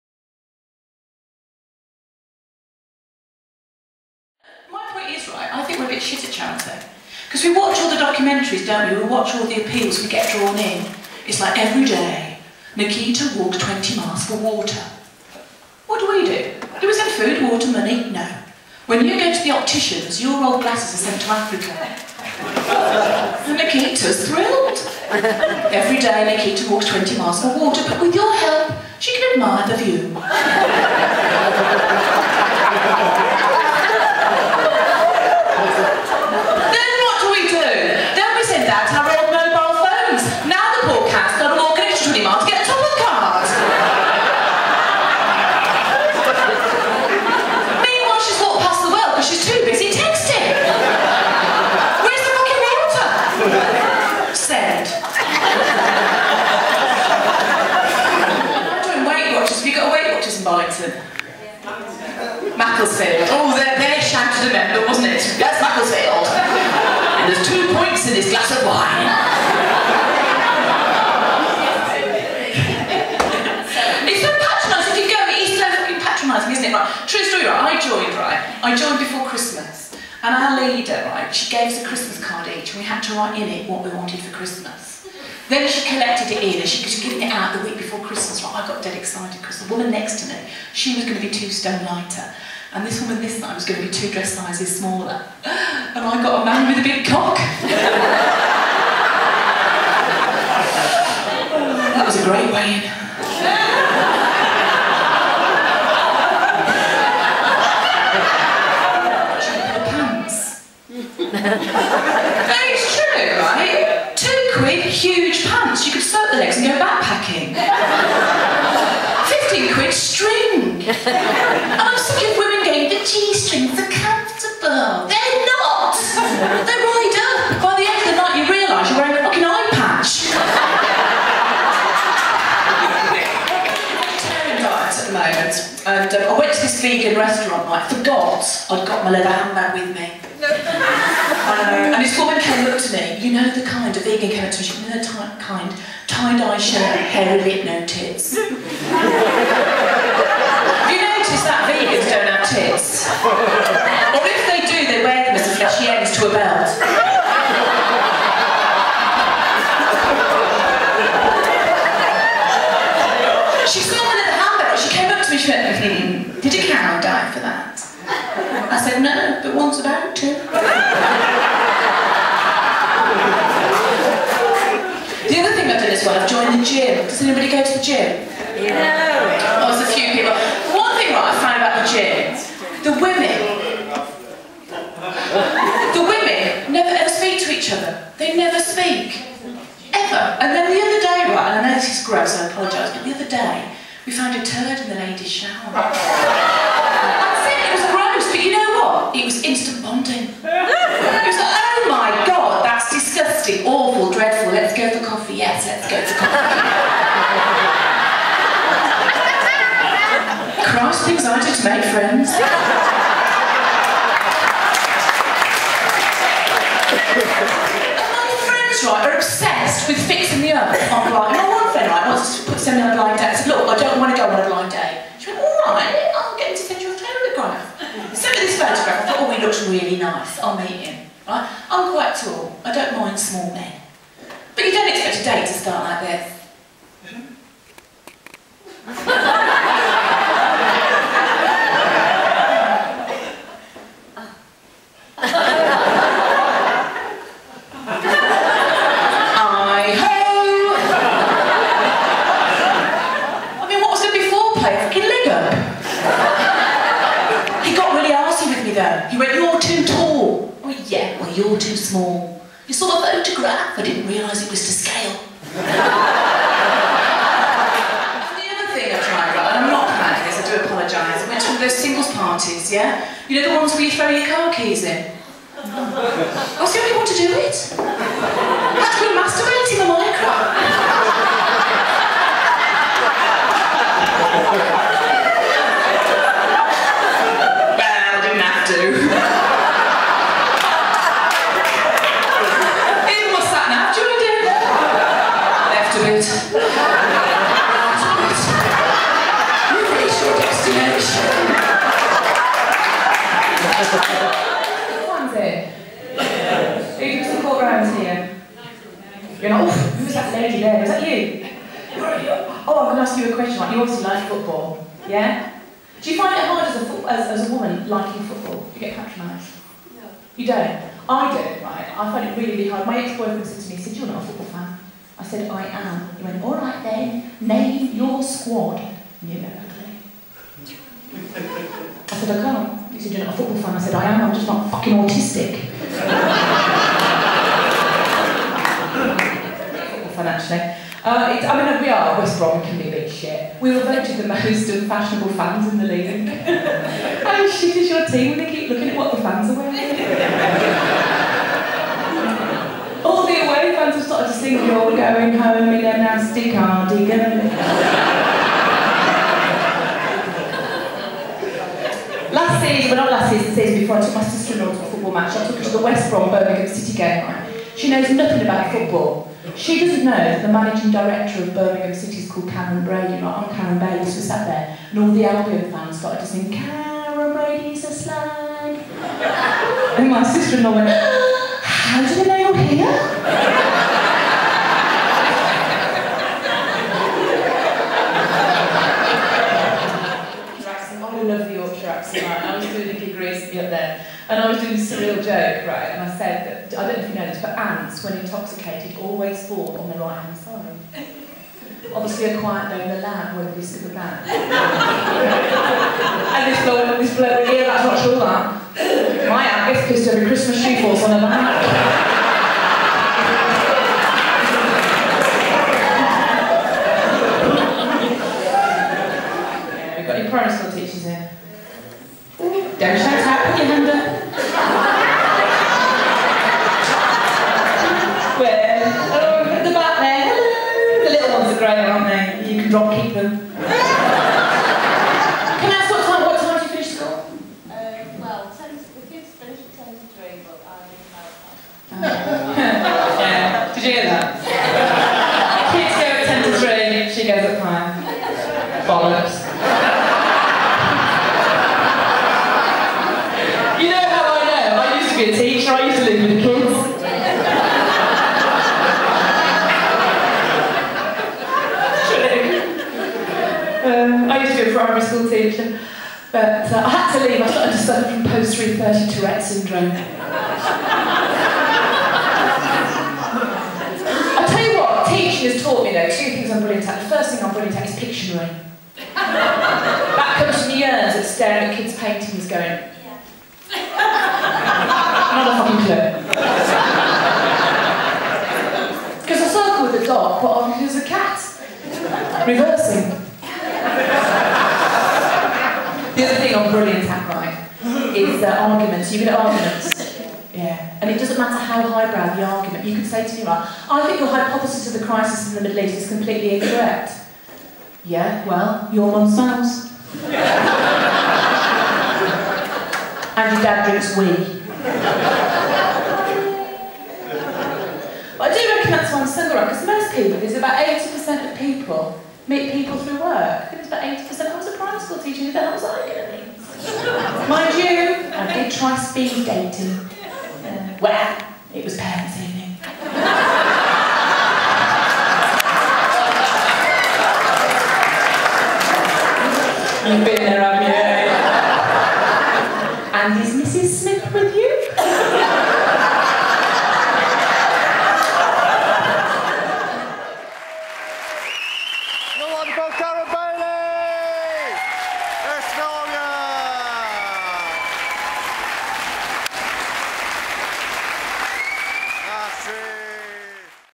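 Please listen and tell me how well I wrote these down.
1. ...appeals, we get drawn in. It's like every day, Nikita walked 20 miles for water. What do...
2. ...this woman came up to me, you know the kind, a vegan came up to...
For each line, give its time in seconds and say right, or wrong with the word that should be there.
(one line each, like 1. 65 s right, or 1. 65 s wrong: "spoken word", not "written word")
1. 9 s right
2. 142 s right.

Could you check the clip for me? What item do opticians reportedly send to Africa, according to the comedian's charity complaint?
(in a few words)
old glasses.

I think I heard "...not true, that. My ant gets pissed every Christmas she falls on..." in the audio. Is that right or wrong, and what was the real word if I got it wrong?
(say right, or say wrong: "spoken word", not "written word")
right.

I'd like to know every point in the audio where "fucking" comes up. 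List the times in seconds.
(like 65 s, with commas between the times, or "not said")
75 s, 129 s, 334 s, 485 s.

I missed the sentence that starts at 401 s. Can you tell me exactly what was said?
Obviously, a quiet day in the lab when not be super bad.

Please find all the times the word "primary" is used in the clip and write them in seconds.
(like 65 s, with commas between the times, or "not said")
464 s, 524 s.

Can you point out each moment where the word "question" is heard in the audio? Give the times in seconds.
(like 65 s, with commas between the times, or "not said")
313 s.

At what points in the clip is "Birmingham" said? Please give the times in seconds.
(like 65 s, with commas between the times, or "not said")
366 s, 371 s.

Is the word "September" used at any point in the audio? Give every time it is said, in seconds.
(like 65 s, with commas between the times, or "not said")
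not said.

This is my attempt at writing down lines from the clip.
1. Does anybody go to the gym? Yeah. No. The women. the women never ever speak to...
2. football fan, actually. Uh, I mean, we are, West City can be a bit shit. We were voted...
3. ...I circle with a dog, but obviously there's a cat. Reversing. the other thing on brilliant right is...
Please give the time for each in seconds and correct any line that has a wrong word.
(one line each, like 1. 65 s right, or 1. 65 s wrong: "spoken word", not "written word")
1. 177 s right
2. 339 s wrong: "Brom", not "City"
3. 489 s right.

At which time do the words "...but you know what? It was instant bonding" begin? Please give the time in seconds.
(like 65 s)
198 s.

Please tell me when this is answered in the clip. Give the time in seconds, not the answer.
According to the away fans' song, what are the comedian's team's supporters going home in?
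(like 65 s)
355 s.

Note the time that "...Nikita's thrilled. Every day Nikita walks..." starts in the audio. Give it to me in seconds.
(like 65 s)
23 s.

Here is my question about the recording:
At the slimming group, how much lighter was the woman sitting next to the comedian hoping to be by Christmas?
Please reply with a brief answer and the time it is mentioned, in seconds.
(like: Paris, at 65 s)
two stone, at 91 s.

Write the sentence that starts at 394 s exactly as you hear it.
And I was doing a surreal joke, right?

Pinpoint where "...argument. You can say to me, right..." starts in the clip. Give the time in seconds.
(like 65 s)
502 s.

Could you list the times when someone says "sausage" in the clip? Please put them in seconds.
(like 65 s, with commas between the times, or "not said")
not said.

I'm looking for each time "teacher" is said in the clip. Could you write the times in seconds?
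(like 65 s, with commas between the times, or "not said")
455 s, 465 s, 525 s.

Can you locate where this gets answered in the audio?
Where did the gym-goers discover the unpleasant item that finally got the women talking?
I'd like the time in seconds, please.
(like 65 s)
194 s.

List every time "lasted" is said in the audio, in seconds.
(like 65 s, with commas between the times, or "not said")
not said.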